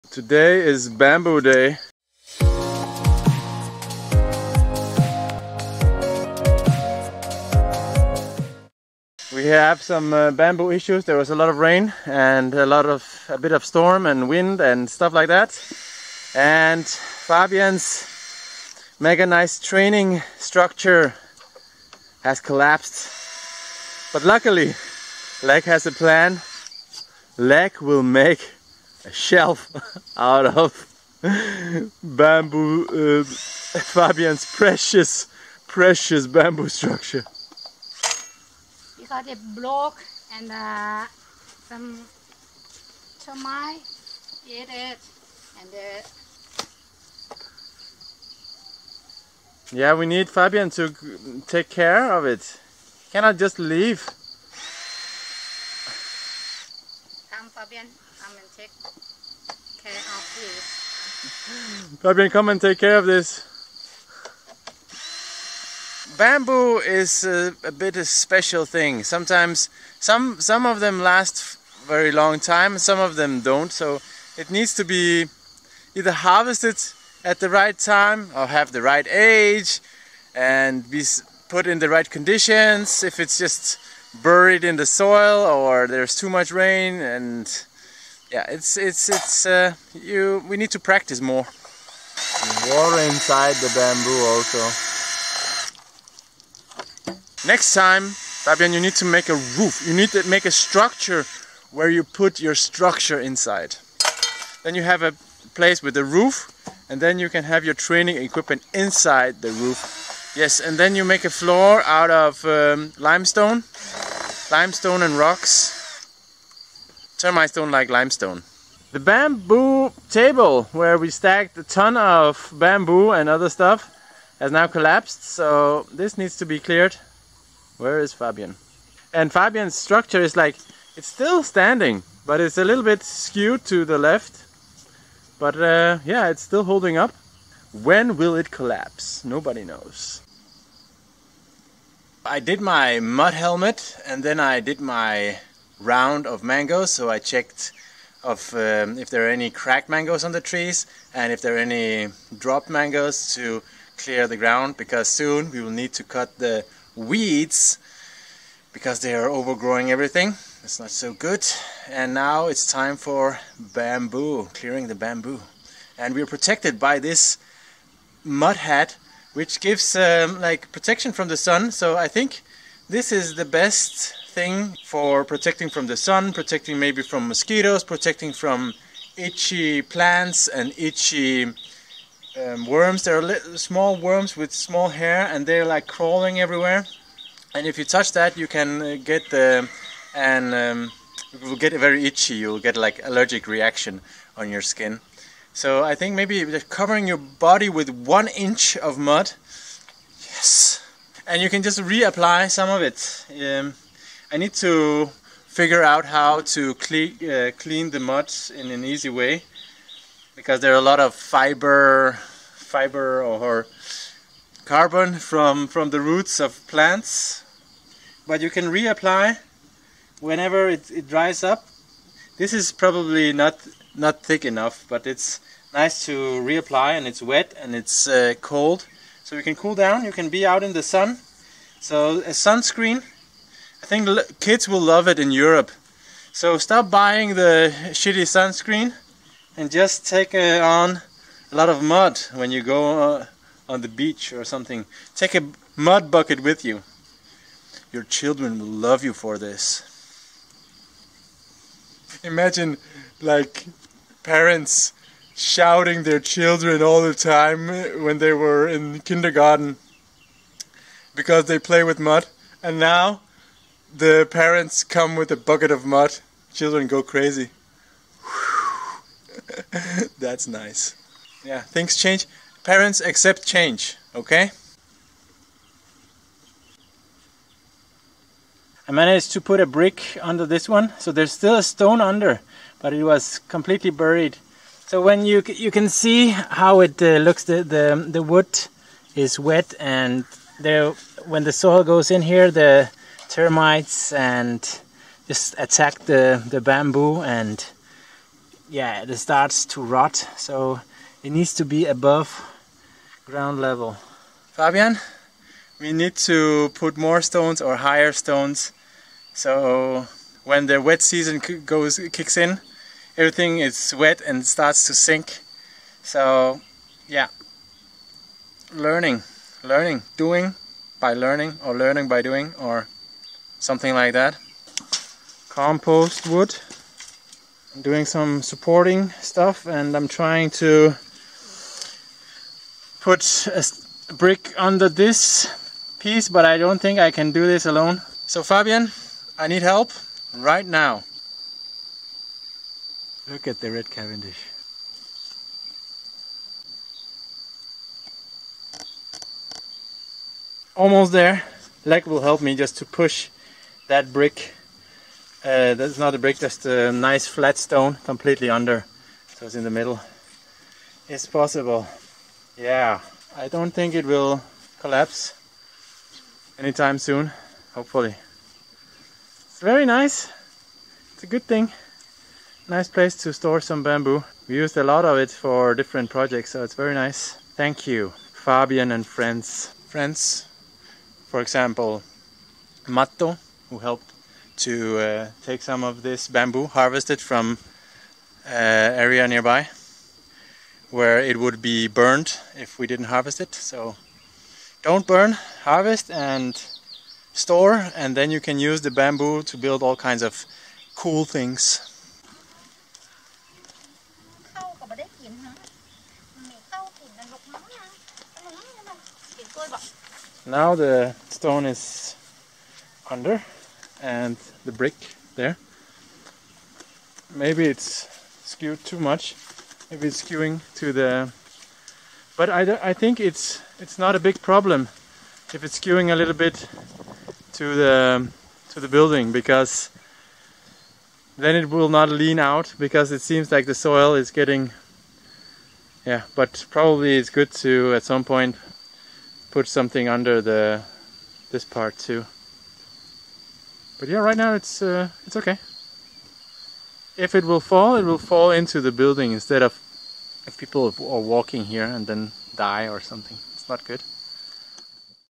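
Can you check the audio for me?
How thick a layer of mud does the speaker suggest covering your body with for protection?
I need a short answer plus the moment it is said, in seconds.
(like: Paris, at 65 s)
One inch, at 197 s.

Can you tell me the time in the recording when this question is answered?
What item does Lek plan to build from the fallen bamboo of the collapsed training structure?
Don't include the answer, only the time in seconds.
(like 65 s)
29 s.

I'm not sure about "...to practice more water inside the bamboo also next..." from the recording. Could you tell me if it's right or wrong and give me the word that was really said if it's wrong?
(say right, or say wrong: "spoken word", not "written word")
right.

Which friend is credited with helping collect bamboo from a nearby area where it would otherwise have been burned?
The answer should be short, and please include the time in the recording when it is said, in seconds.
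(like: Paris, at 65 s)
Matto, at 382 s.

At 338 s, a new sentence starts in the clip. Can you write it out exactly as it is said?
So Fabian, I need help right now.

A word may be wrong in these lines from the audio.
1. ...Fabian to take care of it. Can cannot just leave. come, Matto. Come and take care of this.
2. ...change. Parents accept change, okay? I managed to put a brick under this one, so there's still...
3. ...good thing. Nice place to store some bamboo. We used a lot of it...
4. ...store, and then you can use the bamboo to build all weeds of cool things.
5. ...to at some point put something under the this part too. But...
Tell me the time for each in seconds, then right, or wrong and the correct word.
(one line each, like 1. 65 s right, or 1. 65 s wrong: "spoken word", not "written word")
1. 50 s wrong: "Fabian", not "Matto"
2. 271 s right
3. 371 s right
4. 397 s wrong: "kinds", not "weeds"
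5. 437 s right.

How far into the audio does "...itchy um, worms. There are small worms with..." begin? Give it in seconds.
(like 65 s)
180 s.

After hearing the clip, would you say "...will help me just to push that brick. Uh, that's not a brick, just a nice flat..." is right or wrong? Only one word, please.
right.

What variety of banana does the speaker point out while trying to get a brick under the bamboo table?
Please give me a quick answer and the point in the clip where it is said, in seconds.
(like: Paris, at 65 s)
Red Cavendish, at 343 s.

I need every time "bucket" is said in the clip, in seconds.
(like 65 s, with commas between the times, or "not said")
246 s, 265 s.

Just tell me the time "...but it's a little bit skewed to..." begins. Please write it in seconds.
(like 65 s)
132 s.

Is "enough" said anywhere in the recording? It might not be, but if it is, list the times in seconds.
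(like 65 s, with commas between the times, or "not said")
224 s.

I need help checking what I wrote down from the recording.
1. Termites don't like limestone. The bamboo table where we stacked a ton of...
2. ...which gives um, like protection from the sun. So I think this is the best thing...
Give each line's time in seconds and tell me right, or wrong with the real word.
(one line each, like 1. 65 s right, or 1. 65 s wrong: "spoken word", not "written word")
1. 117 s right
2. 169 s right.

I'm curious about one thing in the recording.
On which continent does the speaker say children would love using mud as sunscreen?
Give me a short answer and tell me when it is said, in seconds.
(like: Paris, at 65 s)
Europe, at 235 s.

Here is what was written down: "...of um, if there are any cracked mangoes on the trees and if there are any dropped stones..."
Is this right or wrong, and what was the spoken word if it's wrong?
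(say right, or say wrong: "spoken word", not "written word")
wrong: "mangoes", not "stones".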